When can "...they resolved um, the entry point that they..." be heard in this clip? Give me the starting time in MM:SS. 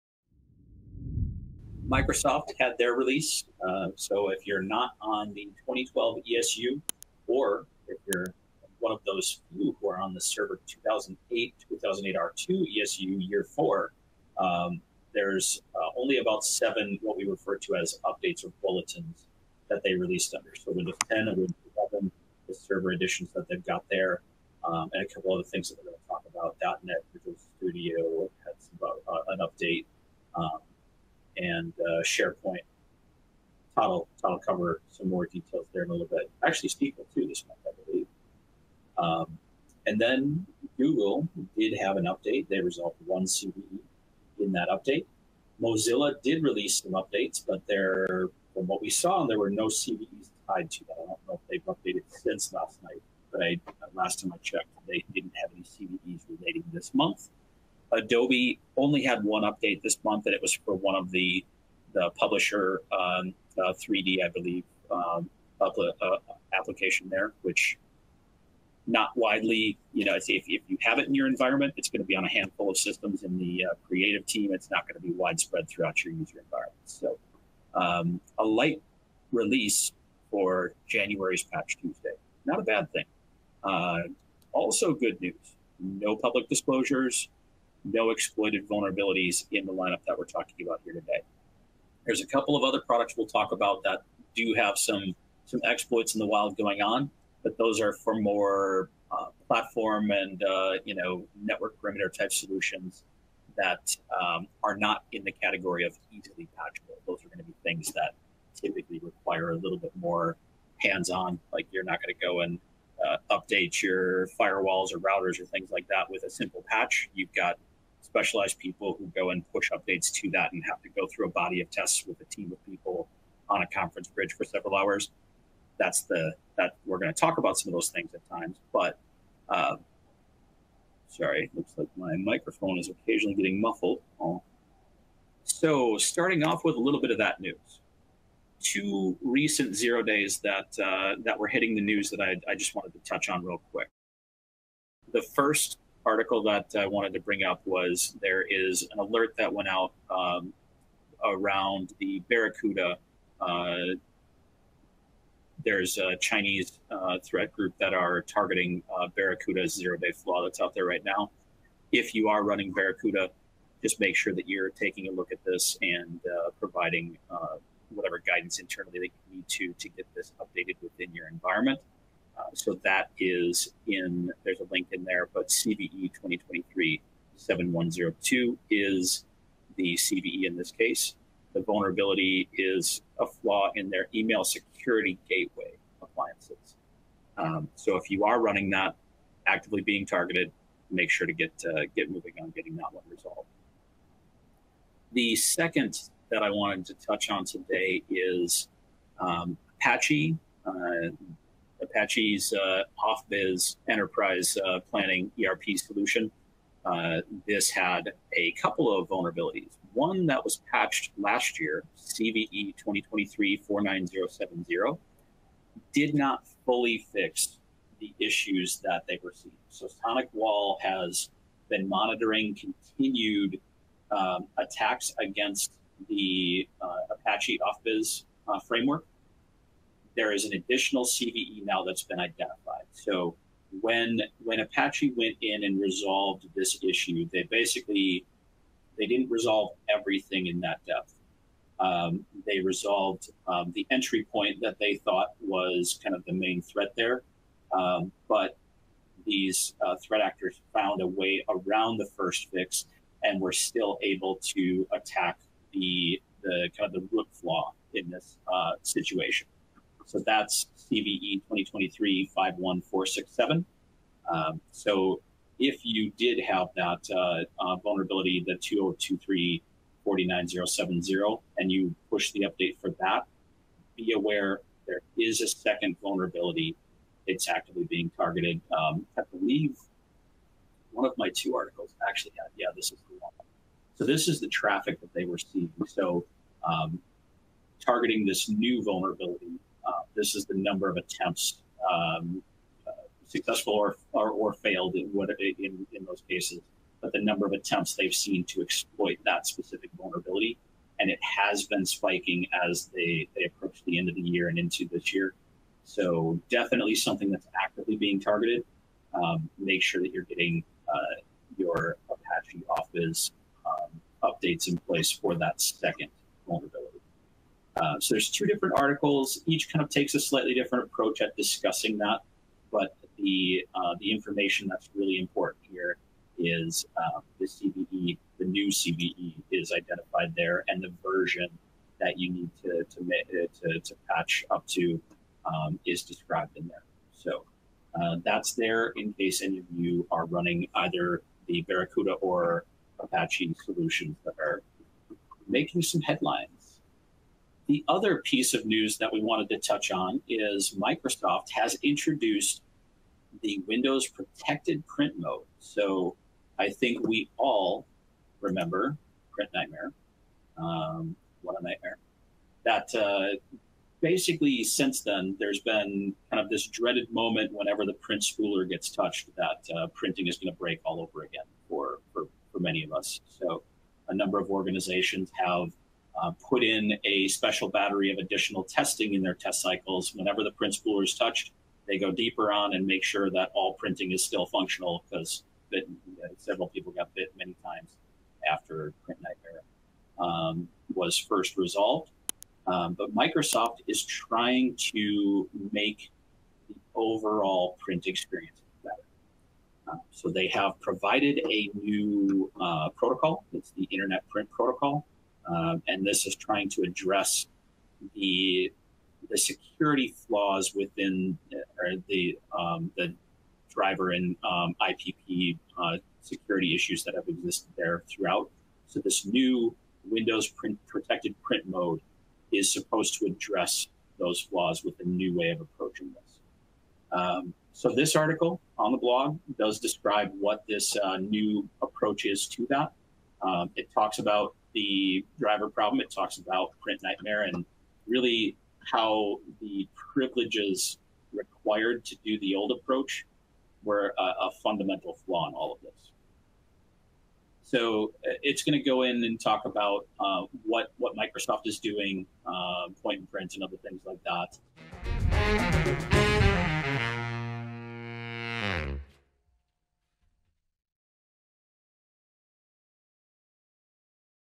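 04:02.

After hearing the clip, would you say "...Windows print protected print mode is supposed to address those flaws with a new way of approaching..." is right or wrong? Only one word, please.
right.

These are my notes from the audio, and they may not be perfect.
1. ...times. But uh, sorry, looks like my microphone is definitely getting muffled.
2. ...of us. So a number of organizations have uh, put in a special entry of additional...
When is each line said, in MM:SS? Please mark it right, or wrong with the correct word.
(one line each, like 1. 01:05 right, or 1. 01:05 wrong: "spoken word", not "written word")
1. 02:08 wrong: "occasionally", not "definitely"
2. 06:12 wrong: "battery", not "entry".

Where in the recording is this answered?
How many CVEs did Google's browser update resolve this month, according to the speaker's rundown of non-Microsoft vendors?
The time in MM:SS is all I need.
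00:43.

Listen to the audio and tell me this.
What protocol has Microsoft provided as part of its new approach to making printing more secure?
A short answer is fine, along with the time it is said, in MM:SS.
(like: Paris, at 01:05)
Internet Print Protocol, at 06:43.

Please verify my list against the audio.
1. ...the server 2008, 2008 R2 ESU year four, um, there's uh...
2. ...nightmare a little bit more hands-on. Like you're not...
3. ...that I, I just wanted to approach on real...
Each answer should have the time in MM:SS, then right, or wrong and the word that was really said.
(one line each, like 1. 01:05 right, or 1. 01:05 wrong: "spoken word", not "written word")
1. 00:10 right
2. 01:48 wrong: "require", not "nightmare"
3. 02:22 wrong: "touch", not "approach".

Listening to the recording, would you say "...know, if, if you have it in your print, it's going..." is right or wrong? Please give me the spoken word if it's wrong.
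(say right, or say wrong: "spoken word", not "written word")
wrong: "environment", not "print".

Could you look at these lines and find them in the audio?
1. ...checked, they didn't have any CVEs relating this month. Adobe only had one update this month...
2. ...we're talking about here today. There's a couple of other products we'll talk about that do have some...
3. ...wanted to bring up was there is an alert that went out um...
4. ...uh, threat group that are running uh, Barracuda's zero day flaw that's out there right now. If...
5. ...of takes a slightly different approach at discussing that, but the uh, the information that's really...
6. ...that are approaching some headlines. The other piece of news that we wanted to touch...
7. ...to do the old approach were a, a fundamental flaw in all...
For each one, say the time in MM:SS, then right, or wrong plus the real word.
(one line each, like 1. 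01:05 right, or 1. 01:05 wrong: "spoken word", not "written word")
1. 00:54 right
2. 01:30 right
3. 02:26 right
4. 02:36 wrong: "targeting", not "running"
5. 05:19 right
6. 05:44 wrong: "making", not "approaching"
7. 07:22 right.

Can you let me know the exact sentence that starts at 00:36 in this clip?
Actually, SQL too this month, I believe.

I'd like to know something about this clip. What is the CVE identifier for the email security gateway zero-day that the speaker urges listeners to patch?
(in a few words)
CVE 2023 7102.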